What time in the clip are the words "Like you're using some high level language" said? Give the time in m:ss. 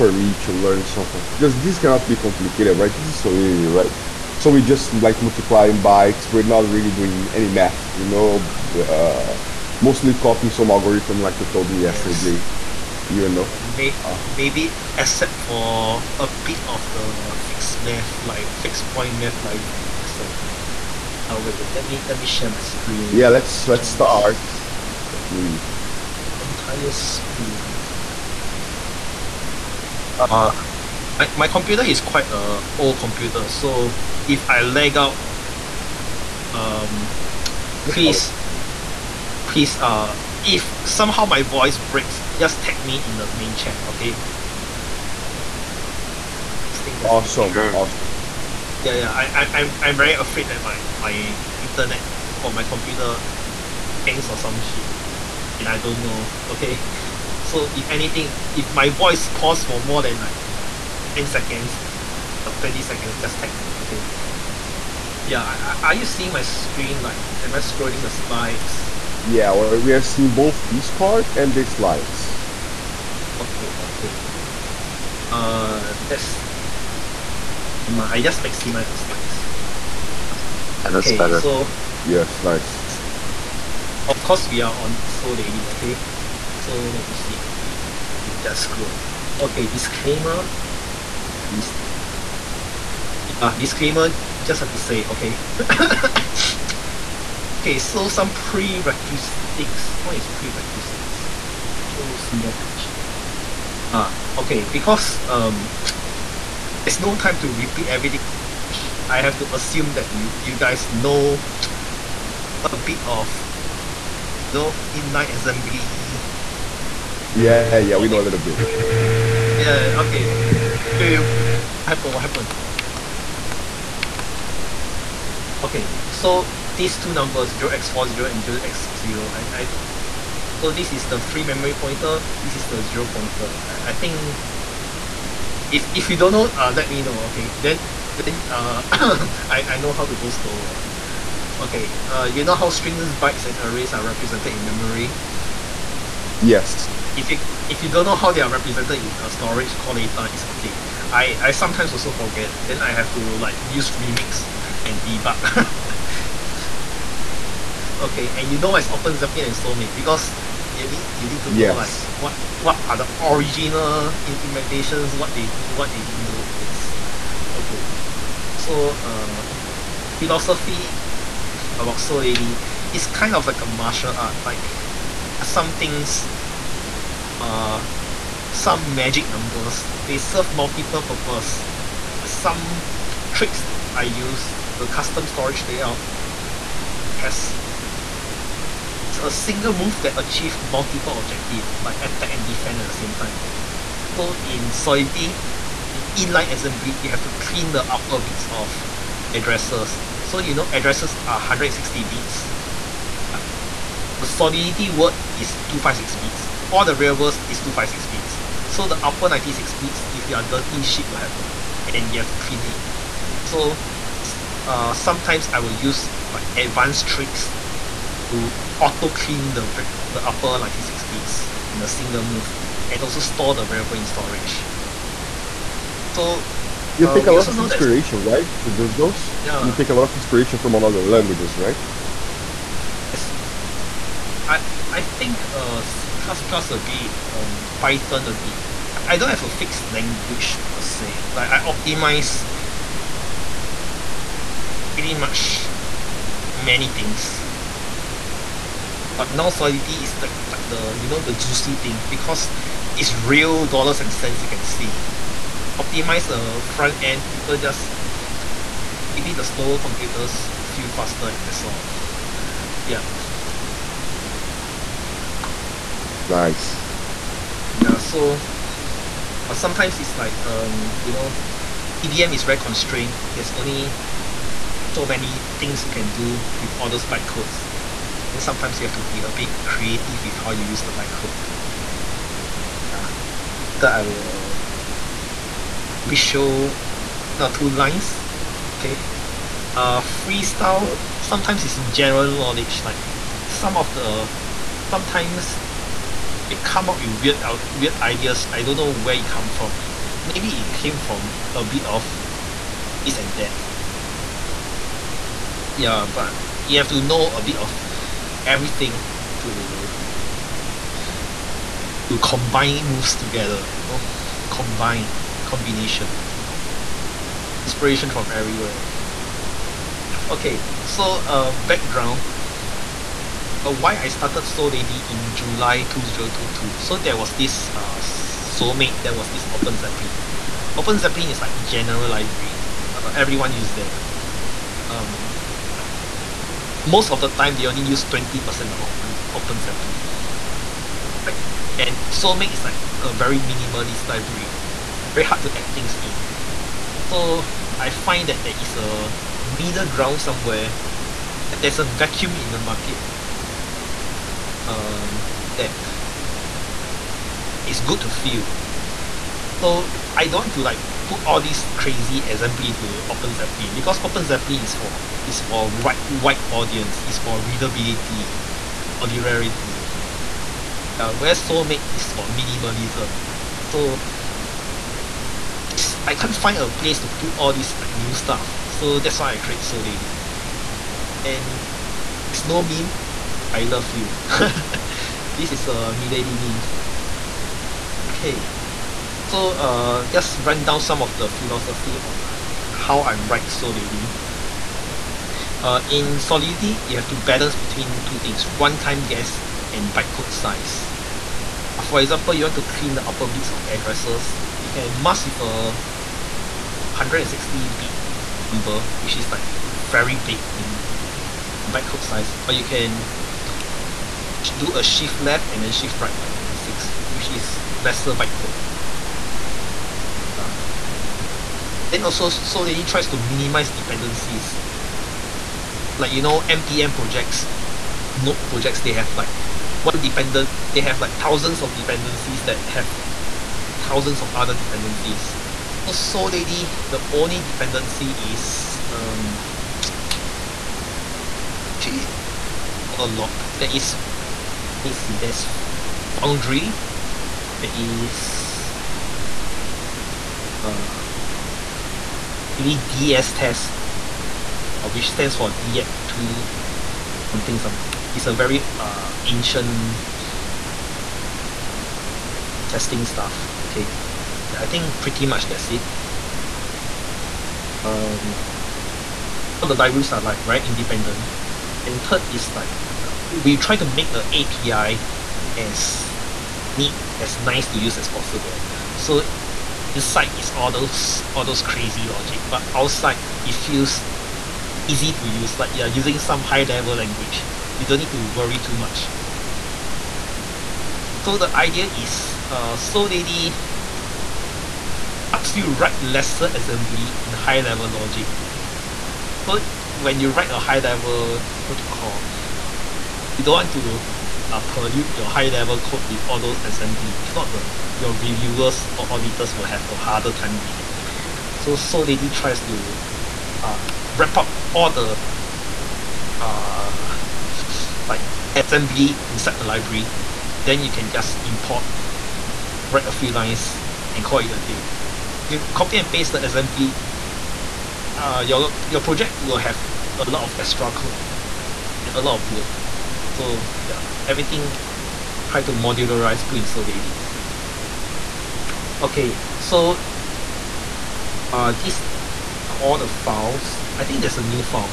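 8:05.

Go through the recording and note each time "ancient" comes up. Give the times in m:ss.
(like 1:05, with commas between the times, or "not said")
7:39.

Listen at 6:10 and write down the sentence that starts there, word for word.
Uh, where Solmate is for minimalism.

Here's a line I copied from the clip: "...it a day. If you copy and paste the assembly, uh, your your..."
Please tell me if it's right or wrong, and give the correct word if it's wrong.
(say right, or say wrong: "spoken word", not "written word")
right.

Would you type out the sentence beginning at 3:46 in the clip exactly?
So you uh, take a lot of inspiration, that...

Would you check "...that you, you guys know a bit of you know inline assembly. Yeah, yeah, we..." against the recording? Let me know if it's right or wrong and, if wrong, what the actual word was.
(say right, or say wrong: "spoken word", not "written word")
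right.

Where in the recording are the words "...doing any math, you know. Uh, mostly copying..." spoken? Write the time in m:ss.
0:06.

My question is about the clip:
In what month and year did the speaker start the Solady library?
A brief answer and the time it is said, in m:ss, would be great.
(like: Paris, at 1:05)
July 2022, at 5:25.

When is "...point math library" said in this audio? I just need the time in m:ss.
0:18.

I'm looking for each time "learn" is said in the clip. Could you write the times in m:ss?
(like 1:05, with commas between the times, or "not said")
0:00.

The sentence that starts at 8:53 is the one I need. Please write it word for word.
So yeah everything try to modularize 不 insert daily.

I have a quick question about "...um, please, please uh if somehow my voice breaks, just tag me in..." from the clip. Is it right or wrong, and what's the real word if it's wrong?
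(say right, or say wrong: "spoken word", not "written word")
right.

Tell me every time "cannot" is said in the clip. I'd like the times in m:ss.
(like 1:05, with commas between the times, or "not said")
0:01.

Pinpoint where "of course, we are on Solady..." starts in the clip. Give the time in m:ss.
1:22.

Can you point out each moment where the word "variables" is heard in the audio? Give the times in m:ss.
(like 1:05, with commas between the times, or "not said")
3:26, 3:43.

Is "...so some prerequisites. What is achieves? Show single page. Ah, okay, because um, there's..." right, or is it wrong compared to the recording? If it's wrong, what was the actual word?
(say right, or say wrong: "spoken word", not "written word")
wrong: "prerequisites", not "achieves".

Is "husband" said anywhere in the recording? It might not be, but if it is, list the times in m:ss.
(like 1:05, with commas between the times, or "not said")
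not said.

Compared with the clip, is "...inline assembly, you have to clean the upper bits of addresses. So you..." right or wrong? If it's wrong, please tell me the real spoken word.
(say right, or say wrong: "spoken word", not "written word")
right.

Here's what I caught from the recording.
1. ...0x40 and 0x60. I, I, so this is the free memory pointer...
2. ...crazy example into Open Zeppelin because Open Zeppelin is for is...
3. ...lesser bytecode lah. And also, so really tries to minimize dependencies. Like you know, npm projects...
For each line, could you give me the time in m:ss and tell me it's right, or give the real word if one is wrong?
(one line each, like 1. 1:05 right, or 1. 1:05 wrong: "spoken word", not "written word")
1. 2:07 right
2. 6:01 right
3. 6:57 right.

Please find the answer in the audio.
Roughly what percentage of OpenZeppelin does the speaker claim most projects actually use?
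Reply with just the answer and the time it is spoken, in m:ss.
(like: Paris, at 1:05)
20%, at 5:38.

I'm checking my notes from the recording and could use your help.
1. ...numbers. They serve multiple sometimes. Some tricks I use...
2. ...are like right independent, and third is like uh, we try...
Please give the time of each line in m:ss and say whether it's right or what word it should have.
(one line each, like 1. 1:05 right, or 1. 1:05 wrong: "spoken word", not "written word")
1. 2:59 wrong: "purposes", not "sometimes"
2. 7:50 right.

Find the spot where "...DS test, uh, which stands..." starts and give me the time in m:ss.
7:32.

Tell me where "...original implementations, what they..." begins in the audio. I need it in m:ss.
2:43.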